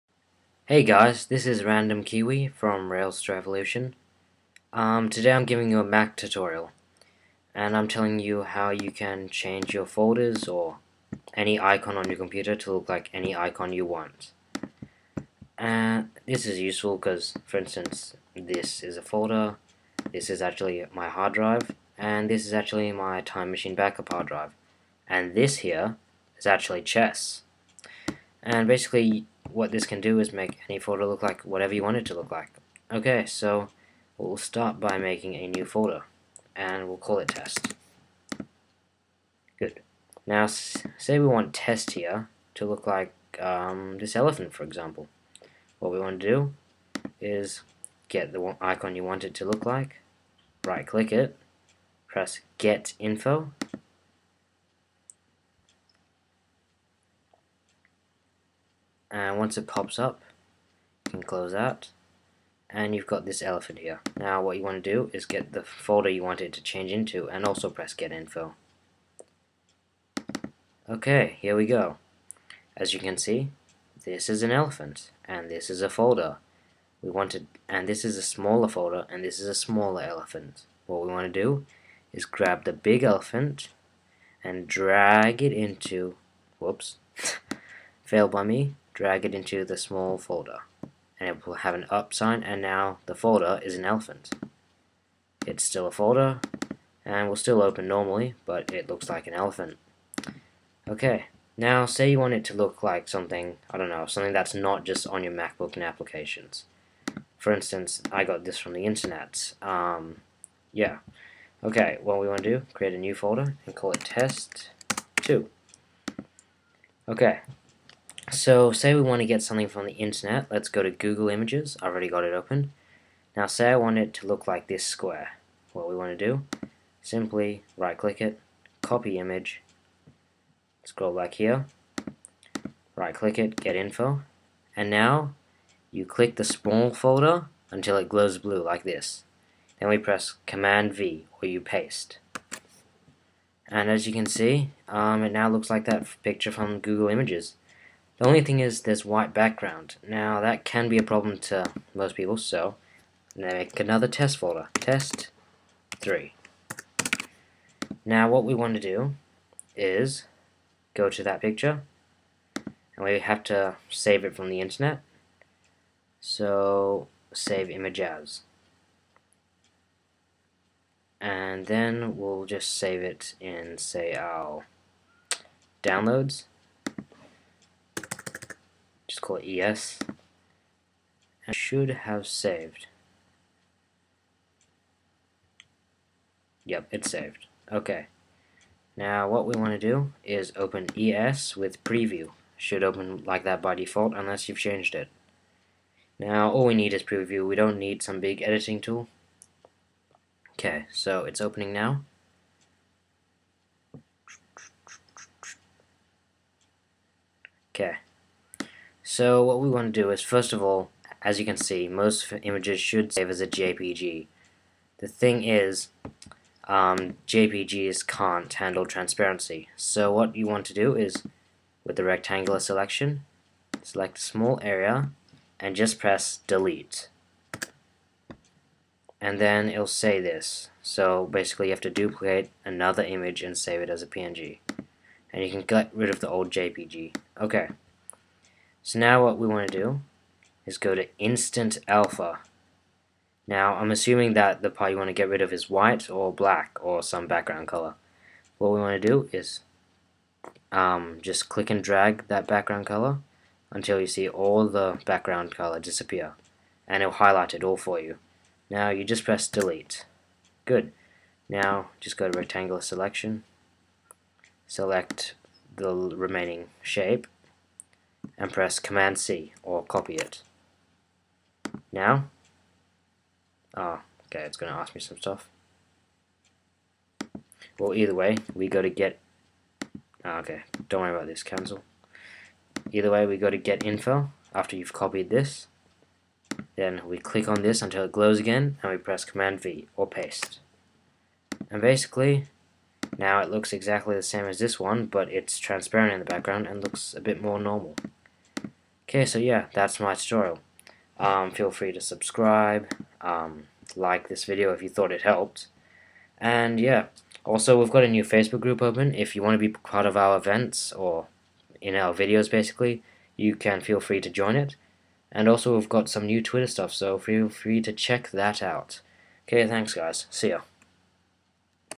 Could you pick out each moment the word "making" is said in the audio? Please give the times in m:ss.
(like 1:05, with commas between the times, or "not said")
0:34.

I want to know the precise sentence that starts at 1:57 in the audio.
Okay, so say we want to get something from the internet, let's go to Google Images, I've already got it open.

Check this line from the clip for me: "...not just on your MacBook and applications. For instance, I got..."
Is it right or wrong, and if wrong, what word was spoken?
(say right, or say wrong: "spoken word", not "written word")
right.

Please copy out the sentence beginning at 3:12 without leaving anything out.
Should open like that by default unless you've changed it.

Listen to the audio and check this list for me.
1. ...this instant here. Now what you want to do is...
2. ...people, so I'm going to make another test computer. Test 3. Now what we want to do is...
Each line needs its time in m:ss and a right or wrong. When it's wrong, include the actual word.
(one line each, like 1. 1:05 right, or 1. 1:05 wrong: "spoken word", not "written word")
1. 1:03 wrong: "elephant", not "instant"
2. 2:32 wrong: "folder", not "computer".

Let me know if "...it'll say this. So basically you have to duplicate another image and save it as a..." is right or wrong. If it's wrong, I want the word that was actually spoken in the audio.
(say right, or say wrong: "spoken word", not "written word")
right.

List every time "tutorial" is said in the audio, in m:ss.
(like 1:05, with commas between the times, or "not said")
0:06, 5:00.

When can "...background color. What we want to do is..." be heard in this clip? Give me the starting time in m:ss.
4:07.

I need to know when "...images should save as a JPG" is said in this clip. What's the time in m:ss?
3:32.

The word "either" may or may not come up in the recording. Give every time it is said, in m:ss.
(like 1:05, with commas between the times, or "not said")
4:37, 4:42.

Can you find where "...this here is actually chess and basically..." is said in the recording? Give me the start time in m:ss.
0:25.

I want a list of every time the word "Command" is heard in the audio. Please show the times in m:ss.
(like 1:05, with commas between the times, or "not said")
2:20, 4:28, 4:49.